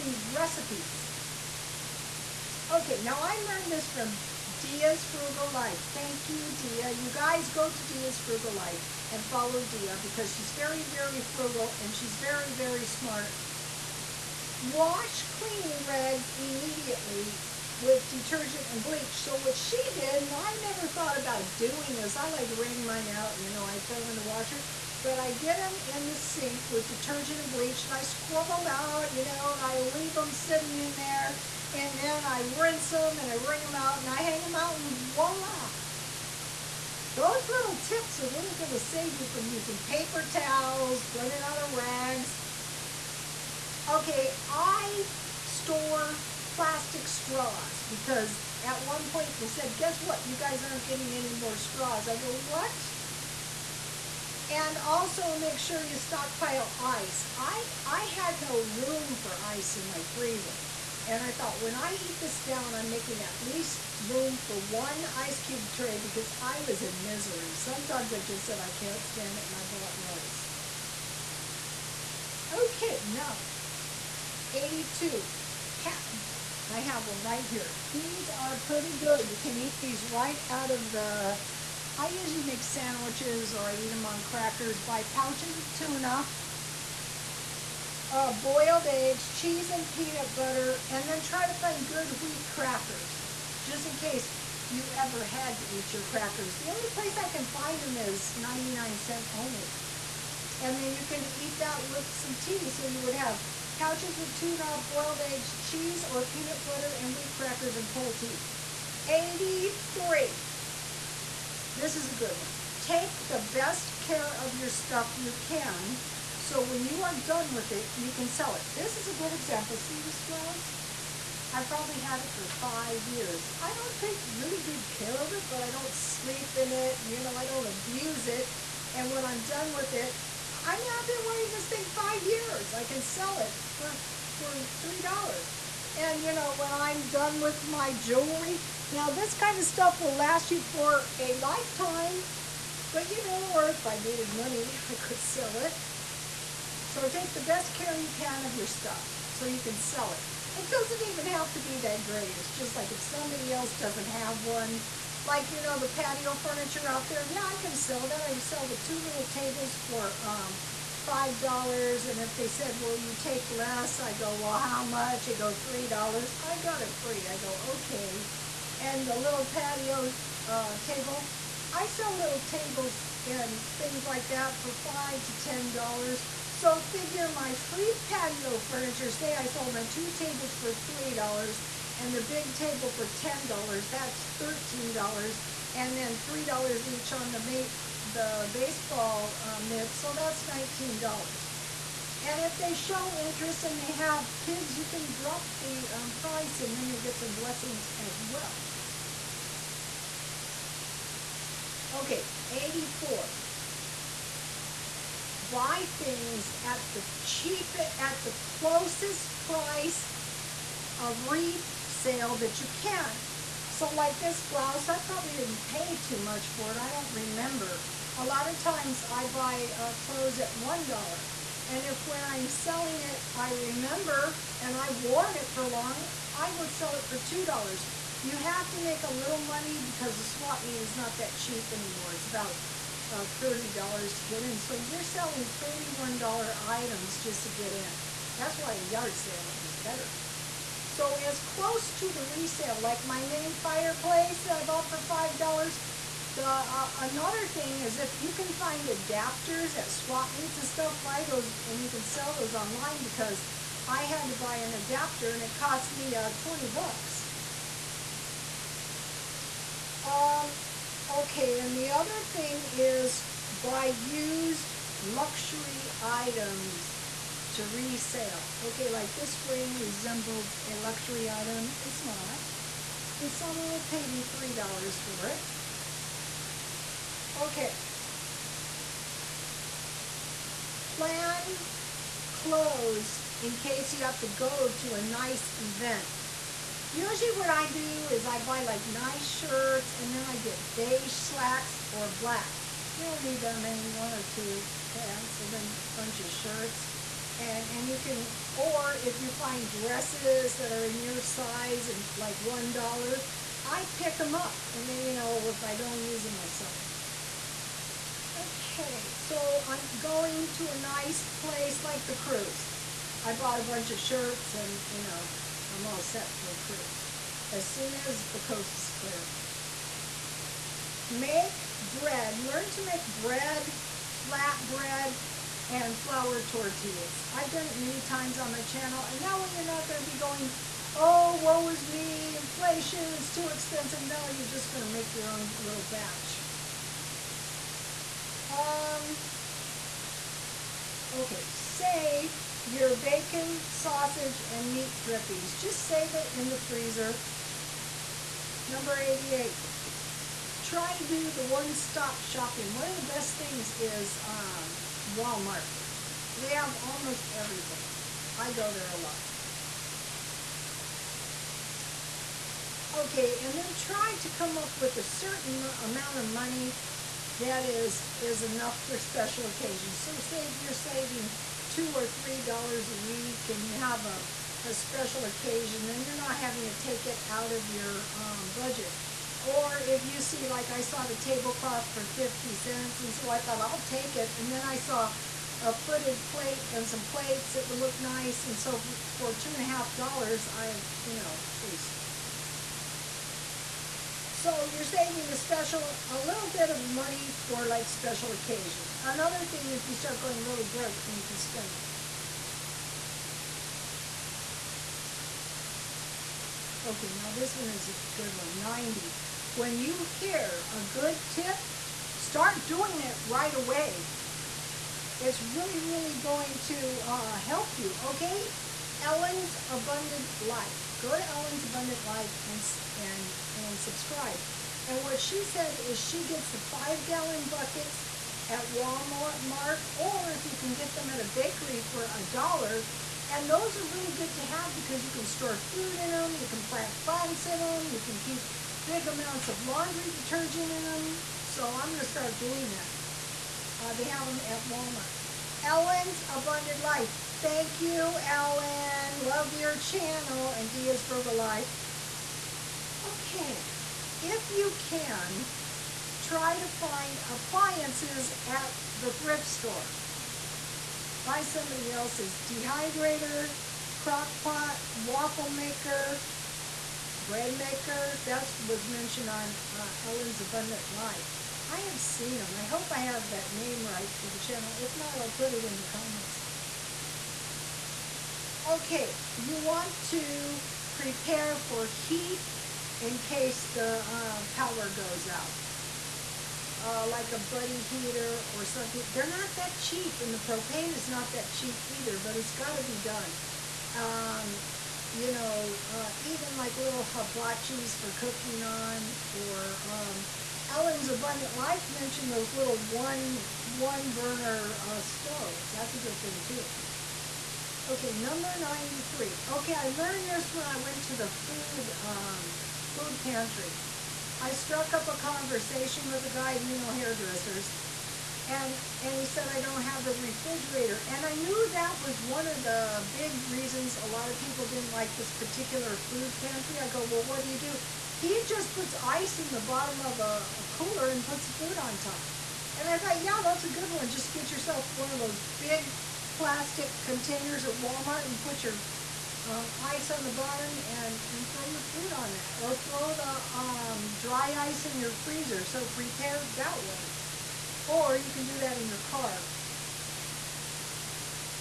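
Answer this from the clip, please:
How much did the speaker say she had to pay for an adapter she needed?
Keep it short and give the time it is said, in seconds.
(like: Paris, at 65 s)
$20, at 256 s.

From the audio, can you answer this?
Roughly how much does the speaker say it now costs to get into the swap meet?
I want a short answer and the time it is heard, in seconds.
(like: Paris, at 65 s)
$30, at 233 s.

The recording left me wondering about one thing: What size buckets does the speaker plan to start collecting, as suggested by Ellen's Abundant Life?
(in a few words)
five gallon.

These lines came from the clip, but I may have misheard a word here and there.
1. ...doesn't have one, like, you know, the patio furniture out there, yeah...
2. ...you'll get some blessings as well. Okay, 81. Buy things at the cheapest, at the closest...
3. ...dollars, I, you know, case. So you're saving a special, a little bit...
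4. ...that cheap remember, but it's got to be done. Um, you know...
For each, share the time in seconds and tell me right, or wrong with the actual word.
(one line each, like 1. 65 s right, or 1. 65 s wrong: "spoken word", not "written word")
1. 153 s right
2. 196 s wrong: "84", not "81"
3. 389 s right
4. 491 s wrong: "either", not "remember".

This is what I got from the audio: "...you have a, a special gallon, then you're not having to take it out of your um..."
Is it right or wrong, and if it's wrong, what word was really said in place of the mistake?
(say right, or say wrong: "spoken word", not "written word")
wrong: "occasion", not "gallon".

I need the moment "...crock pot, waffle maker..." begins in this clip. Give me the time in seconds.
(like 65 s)
463 s.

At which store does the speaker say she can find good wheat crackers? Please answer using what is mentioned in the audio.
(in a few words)
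99 cent only.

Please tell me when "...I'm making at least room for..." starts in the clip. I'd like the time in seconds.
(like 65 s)
62 s.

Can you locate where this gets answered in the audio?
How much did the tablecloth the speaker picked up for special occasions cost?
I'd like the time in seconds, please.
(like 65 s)
382 s.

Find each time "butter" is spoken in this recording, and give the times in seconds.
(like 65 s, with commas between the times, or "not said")
90 s, 106 s.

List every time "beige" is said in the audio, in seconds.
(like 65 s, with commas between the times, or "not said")
290 s.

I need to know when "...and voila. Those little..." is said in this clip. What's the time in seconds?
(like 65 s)
34 s.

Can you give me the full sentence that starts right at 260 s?
Um, okay, and the other thing is buy used luxury items to resale.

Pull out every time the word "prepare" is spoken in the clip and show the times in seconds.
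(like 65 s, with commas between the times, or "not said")
480 s, 545 s.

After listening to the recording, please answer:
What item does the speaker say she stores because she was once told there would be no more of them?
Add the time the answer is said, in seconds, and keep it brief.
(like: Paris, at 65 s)
plastic straws, at 46 s.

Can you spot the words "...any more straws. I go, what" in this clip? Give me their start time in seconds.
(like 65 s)
51 s.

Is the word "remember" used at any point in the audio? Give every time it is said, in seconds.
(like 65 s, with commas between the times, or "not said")
217 s, 223 s.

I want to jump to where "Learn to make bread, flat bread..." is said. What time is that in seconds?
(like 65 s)
322 s.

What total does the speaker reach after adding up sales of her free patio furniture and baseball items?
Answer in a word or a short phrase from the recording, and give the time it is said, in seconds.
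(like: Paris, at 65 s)
$19, at 190 s.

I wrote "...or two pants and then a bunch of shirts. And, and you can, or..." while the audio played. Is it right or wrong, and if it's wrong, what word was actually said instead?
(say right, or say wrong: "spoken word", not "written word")
right.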